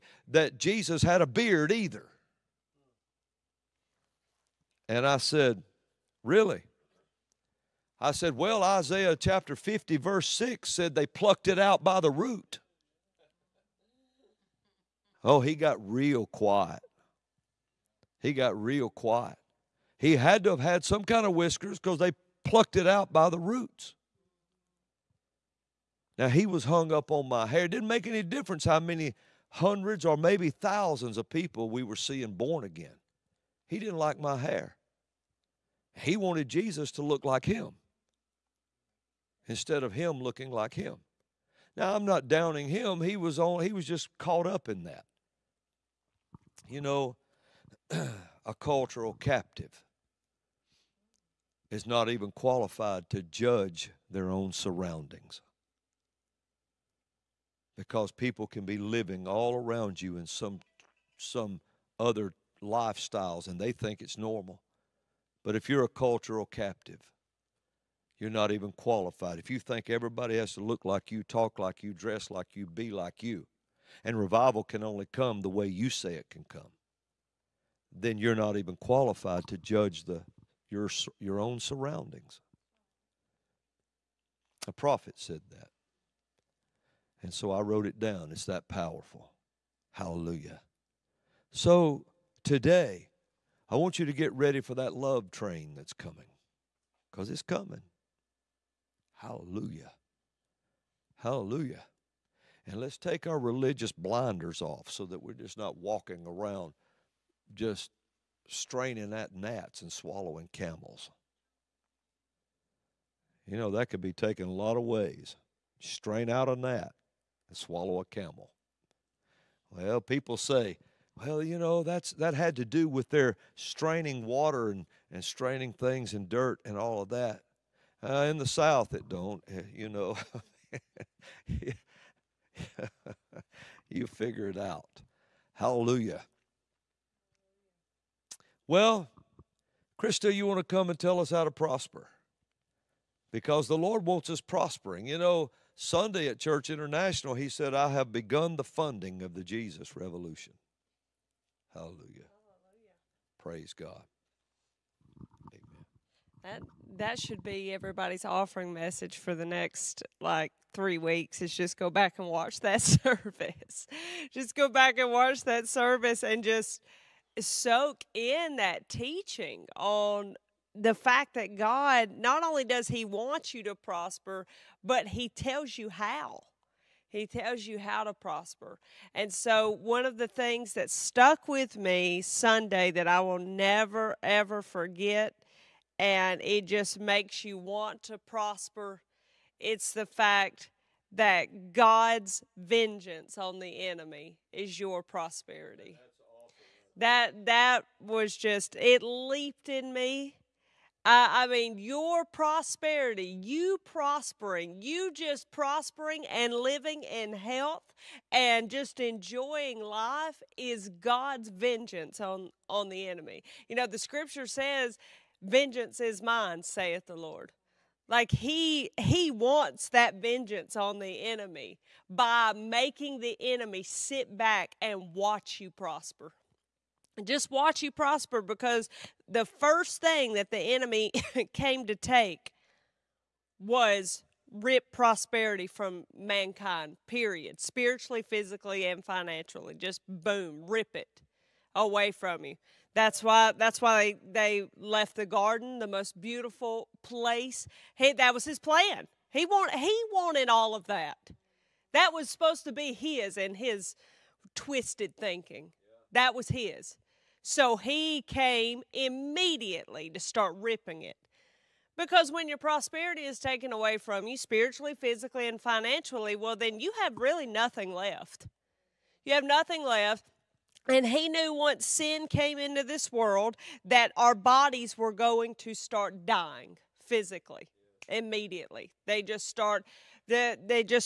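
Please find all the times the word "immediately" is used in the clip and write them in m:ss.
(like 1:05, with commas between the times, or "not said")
4:18, 4:38.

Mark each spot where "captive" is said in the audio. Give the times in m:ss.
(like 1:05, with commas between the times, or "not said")
0:49, 1:06.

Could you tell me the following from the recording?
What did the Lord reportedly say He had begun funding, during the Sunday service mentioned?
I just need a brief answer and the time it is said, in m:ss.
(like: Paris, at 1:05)
The Jesus Revolution, at 2:29.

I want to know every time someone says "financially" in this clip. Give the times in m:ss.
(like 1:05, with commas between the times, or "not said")
3:59, 4:25.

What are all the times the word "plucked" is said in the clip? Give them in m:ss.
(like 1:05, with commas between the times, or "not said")
0:11, 0:22.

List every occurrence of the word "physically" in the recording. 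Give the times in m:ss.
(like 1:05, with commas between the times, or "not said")
3:58, 4:24, 4:37.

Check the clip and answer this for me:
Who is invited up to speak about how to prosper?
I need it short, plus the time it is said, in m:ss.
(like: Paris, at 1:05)
Krista, at 2:19.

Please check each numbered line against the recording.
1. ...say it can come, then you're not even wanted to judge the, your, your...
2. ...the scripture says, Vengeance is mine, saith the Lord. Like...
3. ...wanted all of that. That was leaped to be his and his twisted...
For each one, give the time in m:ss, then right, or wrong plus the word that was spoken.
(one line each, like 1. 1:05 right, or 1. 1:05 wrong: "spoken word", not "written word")
1. 1:15 wrong: "qualified", not "wanted"
2. 3:33 right
3. 4:10 wrong: "supposed", not "leaped".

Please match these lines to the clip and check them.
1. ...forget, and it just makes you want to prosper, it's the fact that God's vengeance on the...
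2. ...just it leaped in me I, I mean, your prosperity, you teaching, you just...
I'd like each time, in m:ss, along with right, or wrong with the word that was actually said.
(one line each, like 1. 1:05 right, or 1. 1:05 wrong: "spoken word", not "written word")
1. 3:04 right
2. 3:18 wrong: "prospering", not "teaching".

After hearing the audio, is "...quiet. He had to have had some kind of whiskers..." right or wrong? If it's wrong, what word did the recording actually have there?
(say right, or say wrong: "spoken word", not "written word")
right.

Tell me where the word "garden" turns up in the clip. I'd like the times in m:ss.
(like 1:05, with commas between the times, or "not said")
4:05.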